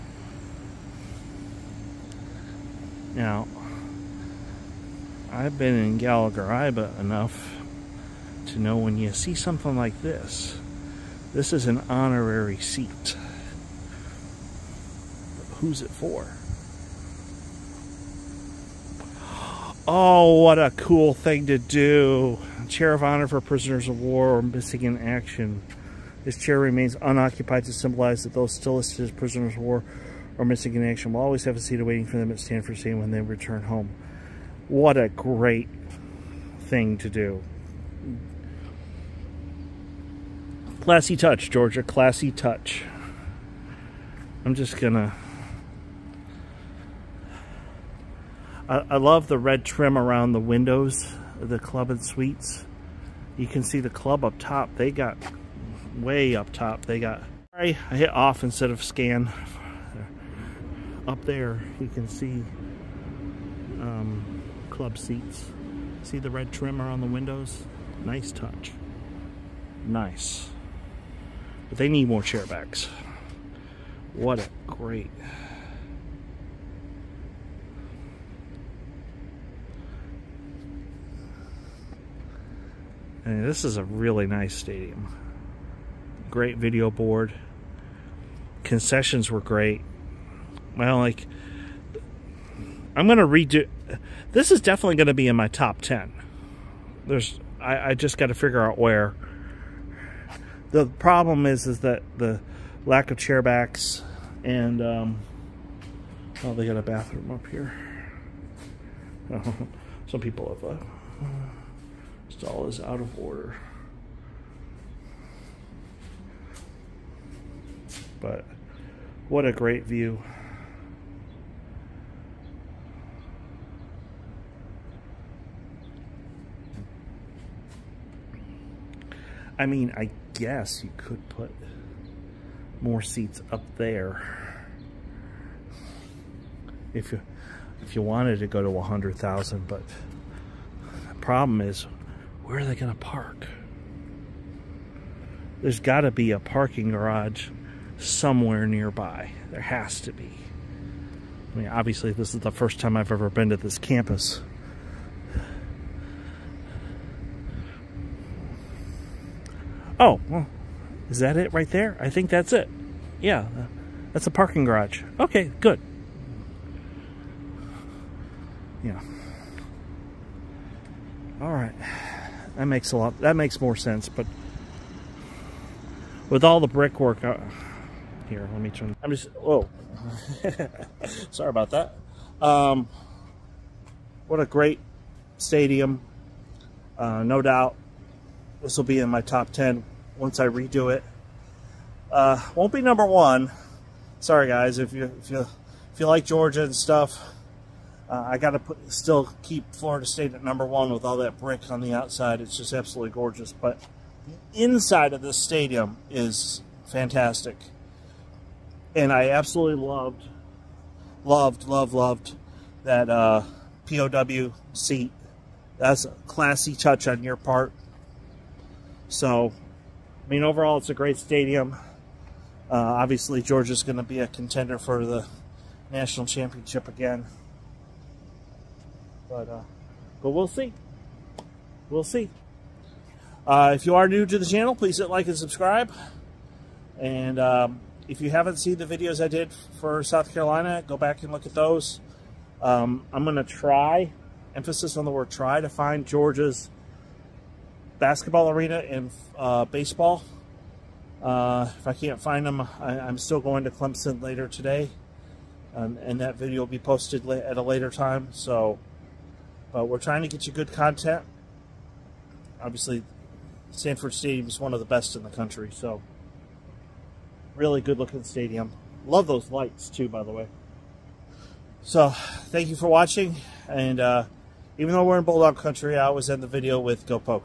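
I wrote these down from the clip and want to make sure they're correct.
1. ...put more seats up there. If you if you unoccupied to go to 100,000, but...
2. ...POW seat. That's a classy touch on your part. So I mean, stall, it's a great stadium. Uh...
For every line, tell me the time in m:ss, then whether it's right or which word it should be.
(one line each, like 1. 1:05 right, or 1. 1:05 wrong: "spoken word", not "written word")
1. 2:11 wrong: "wanted", not "unoccupied"
2. 3:33 wrong: "overall", not "stall".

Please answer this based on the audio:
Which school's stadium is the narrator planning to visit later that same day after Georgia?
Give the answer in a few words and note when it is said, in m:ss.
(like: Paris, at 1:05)
Clemson, at 4:13.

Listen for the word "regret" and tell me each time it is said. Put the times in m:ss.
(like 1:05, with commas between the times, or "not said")
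not said.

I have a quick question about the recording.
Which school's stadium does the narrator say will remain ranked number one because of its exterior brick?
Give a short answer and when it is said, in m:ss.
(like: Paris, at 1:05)
Florida State, at 3:19.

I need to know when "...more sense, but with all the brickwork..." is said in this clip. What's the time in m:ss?
2:53.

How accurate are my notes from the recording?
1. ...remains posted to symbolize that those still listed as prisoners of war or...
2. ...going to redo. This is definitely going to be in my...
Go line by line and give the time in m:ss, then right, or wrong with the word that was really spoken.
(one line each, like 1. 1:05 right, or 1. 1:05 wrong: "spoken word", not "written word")
1. 0:26 wrong: "unoccupied", not "posted"
2. 1:33 right.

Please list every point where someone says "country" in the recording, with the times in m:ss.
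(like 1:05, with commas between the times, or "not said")
4:25, 4:35.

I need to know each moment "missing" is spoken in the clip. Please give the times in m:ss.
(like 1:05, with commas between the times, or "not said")
0:24, 0:30.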